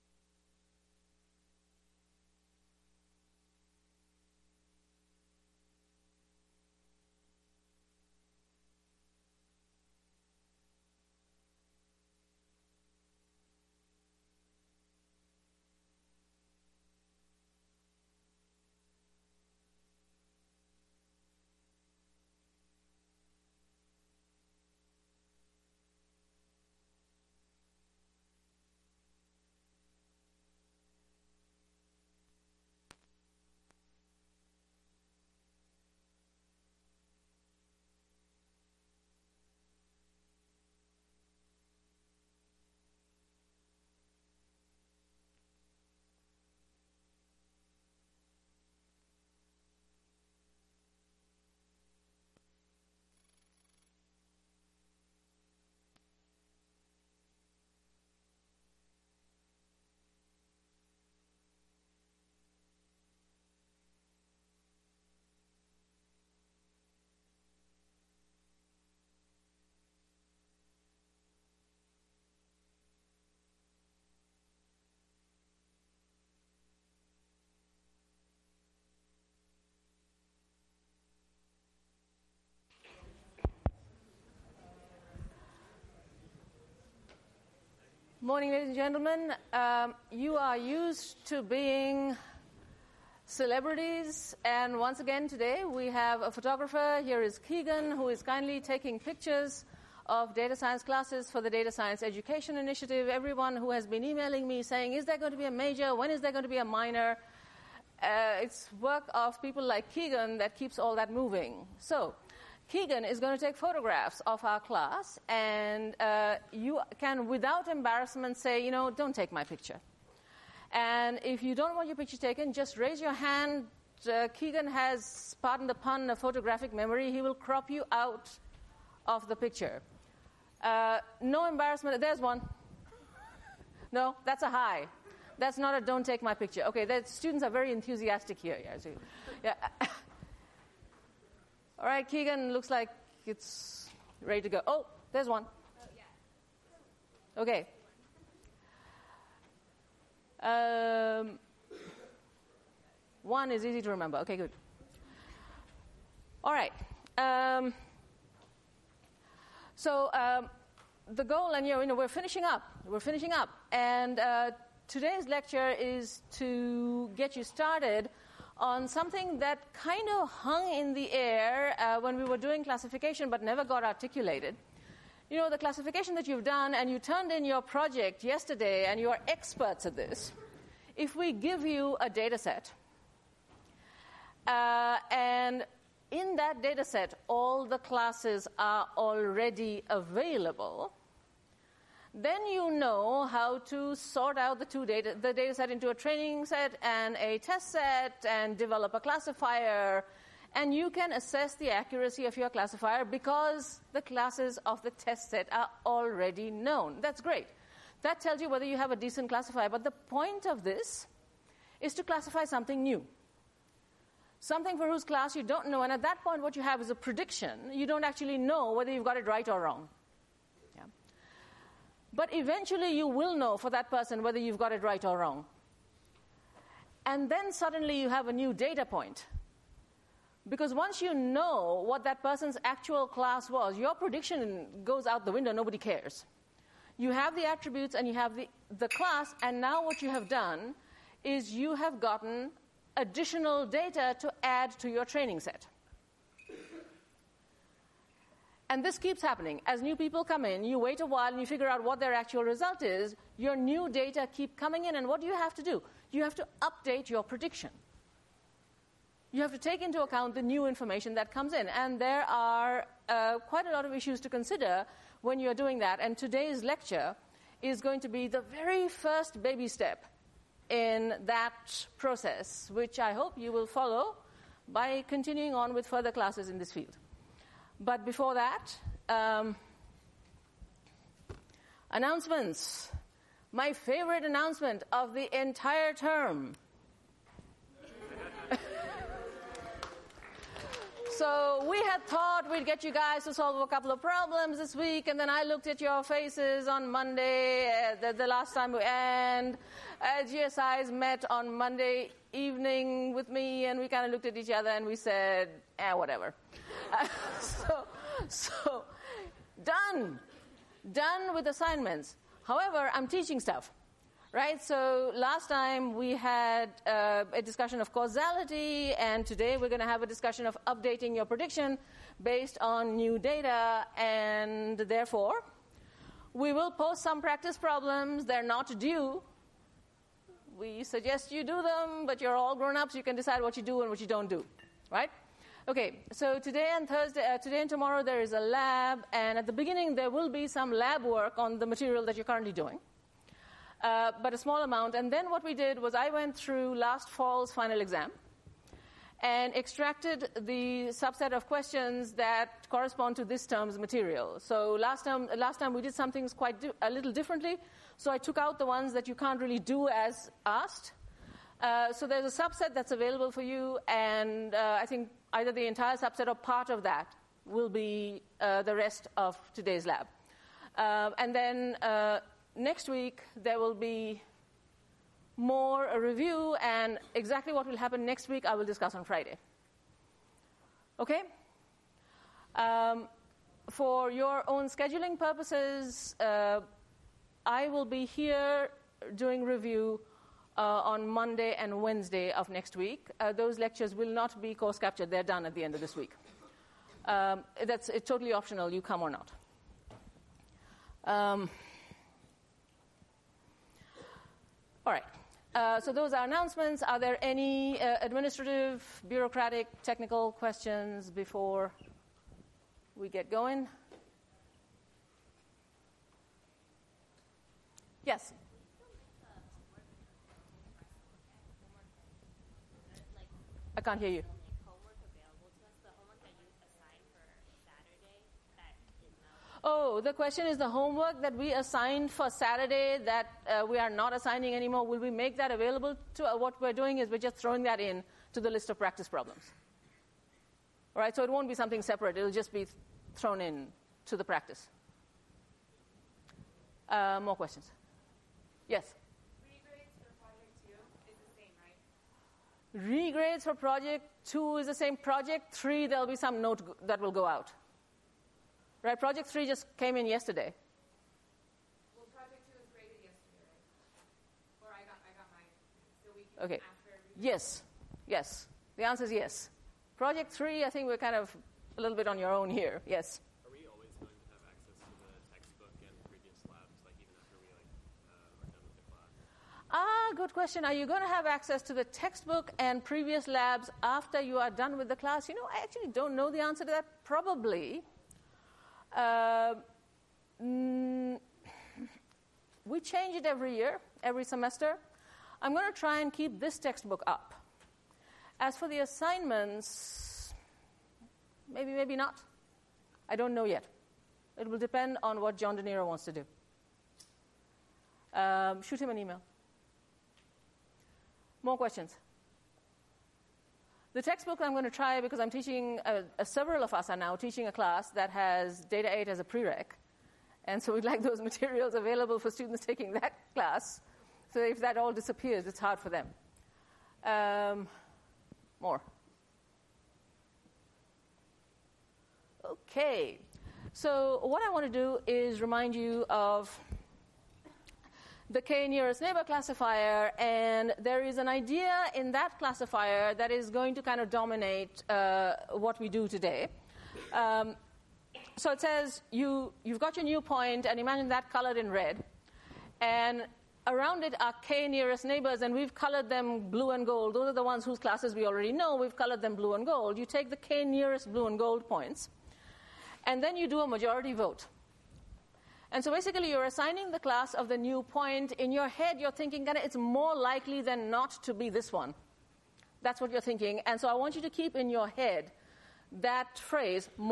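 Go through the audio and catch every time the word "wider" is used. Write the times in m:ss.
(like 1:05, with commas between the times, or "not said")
not said.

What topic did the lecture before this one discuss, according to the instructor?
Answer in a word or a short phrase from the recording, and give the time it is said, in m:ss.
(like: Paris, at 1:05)
causality, at 5:17.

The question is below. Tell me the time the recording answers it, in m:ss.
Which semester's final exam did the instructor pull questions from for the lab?
5:46.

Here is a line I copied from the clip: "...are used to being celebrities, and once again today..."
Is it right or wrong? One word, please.
right.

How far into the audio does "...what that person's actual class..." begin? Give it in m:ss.
3:51.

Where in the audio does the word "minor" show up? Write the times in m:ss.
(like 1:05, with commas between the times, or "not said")
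1:46.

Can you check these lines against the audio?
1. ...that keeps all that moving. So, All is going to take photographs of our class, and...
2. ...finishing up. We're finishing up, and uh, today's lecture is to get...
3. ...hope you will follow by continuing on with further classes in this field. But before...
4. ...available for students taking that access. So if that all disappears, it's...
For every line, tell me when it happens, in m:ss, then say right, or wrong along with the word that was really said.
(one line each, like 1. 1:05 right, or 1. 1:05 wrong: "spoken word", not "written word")
1. 1:50 wrong: "Keegan", not "All"
2. 2:42 right
3. 4:33 right
4. 8:41 wrong: "class", not "access".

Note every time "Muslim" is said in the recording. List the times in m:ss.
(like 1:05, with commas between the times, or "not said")
not said.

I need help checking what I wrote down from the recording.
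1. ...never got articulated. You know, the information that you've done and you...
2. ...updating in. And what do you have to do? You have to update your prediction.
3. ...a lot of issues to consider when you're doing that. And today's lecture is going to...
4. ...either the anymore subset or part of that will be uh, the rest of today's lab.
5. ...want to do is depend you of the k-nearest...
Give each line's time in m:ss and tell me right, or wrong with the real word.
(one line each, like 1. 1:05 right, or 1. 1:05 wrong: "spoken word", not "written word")
1. 2:53 wrong: "classification", not "information"
2. 4:14 wrong: "coming", not "updating"
3. 4:23 right
4. 6:05 wrong: "entire", not "anymore"
5. 8:54 wrong: "remind", not "depend".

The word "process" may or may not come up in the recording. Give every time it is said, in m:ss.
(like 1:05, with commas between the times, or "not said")
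4:31.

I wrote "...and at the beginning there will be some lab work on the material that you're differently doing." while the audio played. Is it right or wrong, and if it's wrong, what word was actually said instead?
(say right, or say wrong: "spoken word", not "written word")
wrong: "currently", not "differently".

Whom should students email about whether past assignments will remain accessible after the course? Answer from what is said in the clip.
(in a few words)
John DeNero.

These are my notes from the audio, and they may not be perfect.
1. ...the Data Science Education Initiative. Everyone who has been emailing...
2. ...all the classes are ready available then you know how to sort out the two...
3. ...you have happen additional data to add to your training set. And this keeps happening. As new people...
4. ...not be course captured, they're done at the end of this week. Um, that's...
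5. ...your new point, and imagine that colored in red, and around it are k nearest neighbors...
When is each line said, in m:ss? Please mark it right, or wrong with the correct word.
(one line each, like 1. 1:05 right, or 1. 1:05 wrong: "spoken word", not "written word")
1. 1:41 right
2. 3:07 wrong: "already", not "ready"
3. 4:01 wrong: "gotten", not "happen"
4. 6:34 right
5. 9:09 right.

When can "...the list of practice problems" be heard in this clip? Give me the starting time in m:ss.
7:18.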